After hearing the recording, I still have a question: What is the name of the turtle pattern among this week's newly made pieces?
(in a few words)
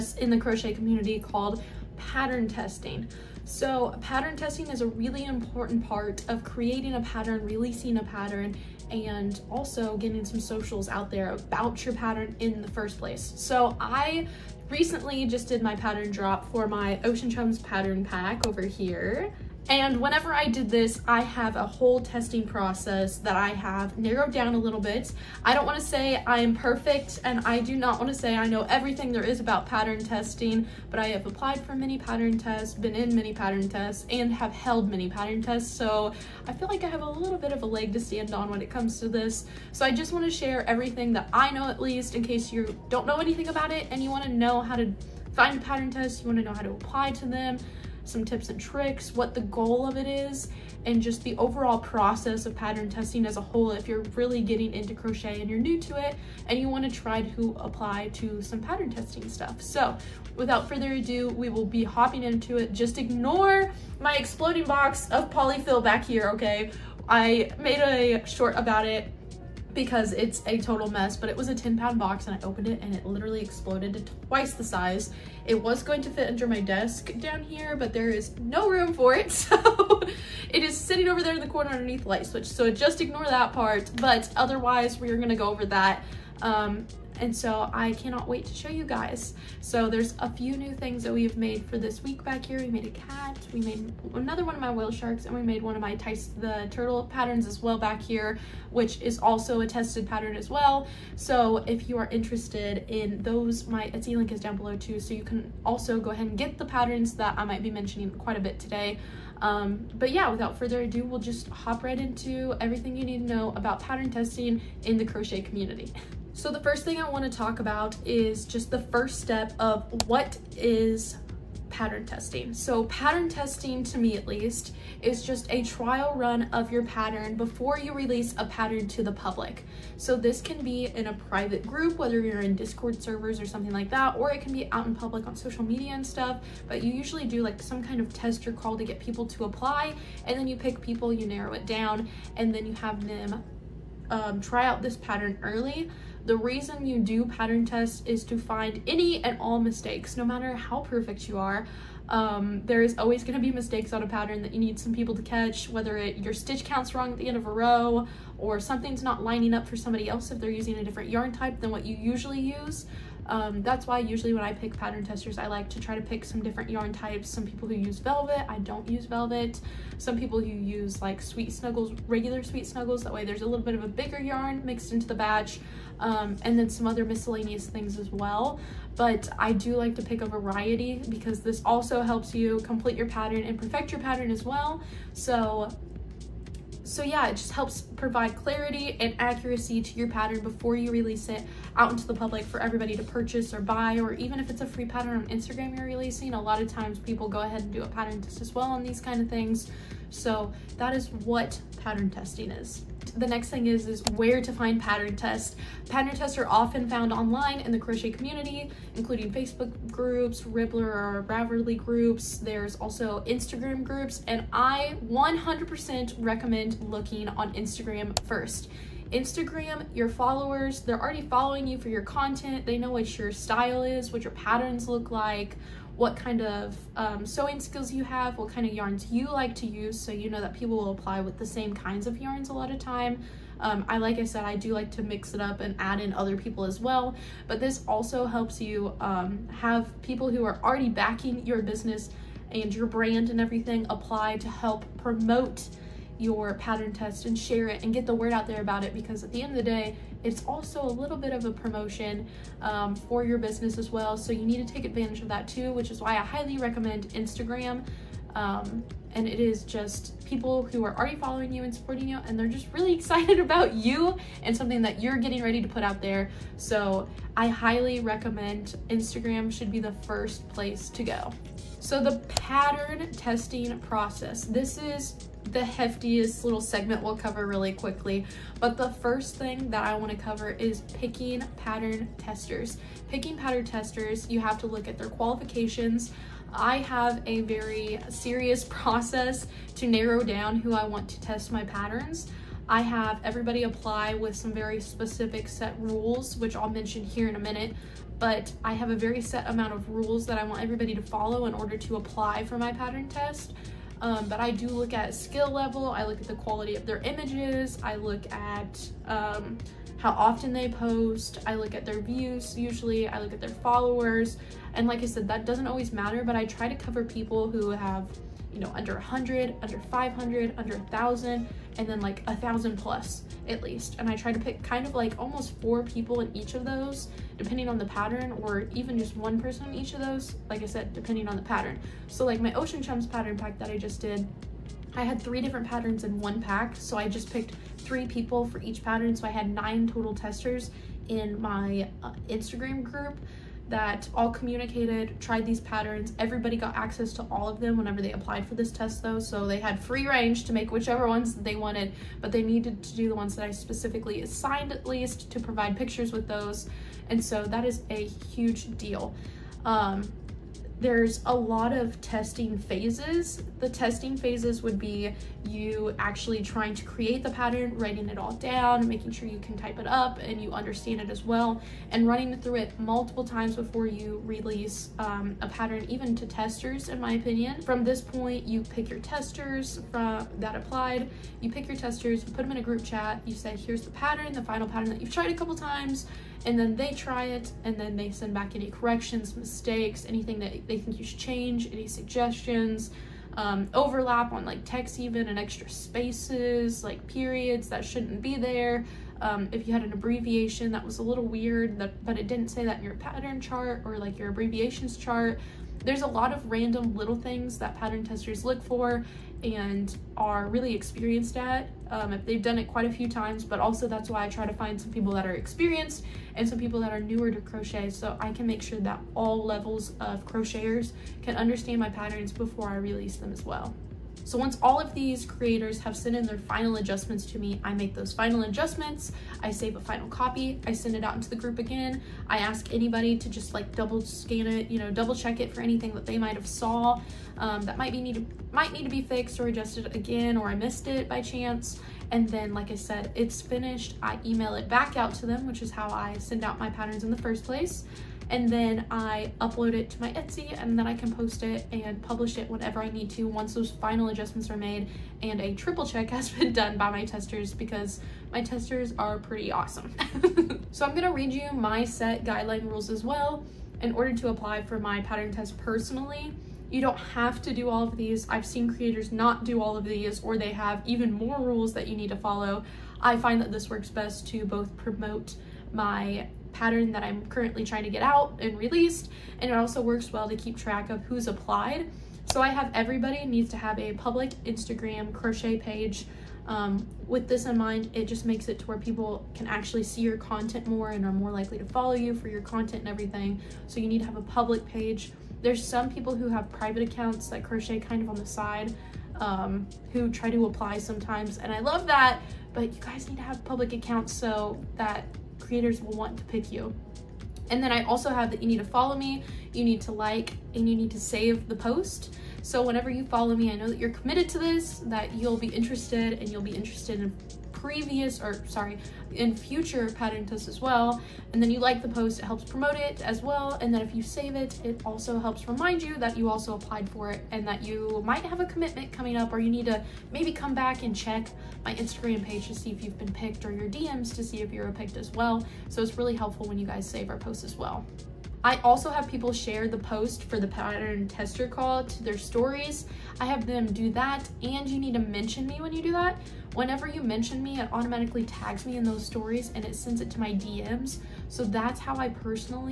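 Tice.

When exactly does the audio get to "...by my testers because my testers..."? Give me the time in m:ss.
7:36.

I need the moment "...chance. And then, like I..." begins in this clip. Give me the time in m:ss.
7:21.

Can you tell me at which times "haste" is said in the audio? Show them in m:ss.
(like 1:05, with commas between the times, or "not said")
not said.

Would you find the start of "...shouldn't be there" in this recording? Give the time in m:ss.
6:37.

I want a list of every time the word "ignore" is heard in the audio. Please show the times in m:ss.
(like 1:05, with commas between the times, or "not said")
1:02, 1:23.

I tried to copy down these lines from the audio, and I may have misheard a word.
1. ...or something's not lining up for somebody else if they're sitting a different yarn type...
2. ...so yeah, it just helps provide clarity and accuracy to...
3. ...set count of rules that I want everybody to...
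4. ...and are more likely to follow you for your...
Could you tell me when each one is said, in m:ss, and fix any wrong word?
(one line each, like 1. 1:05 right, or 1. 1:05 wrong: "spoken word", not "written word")
1. 2:38 wrong: "using", not "sitting"
2. 3:06 right
3. 4:59 wrong: "amount", not "count"
4. 8:10 right.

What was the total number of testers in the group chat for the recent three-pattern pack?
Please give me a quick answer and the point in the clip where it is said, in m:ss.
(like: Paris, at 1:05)
9, at 5:39.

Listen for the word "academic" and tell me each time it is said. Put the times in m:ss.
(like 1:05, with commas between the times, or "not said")
not said.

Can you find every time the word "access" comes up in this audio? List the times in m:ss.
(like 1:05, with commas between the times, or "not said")
5:46.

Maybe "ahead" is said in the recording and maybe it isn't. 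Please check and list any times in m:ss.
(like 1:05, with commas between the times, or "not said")
1:46, 3:17.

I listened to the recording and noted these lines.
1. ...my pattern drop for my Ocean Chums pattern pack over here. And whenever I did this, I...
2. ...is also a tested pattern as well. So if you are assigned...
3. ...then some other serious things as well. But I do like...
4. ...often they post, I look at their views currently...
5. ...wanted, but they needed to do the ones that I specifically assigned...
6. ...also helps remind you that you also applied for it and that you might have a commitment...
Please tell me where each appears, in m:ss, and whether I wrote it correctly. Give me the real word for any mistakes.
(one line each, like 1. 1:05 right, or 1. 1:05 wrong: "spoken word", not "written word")
1. 0:15 right
2. 1:39 wrong: "interested", not "assigned"
3. 2:56 wrong: "miscellaneous", not "serious"
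4. 5:10 wrong: "usually", not "currently"
5. 5:51 right
6. 8:44 right.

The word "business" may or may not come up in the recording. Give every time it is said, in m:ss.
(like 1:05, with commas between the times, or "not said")
4:01, 4:13.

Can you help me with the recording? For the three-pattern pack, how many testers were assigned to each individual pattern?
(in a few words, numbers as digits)
3.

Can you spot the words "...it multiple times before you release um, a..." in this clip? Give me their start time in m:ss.
6:12.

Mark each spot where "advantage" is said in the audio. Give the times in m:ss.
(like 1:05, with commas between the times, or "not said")
4:14.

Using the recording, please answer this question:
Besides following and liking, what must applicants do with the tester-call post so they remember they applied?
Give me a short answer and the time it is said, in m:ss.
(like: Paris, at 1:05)
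save the post, at 8:30.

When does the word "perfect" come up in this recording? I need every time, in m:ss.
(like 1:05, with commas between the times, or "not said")
0:26, 2:30, 3:03.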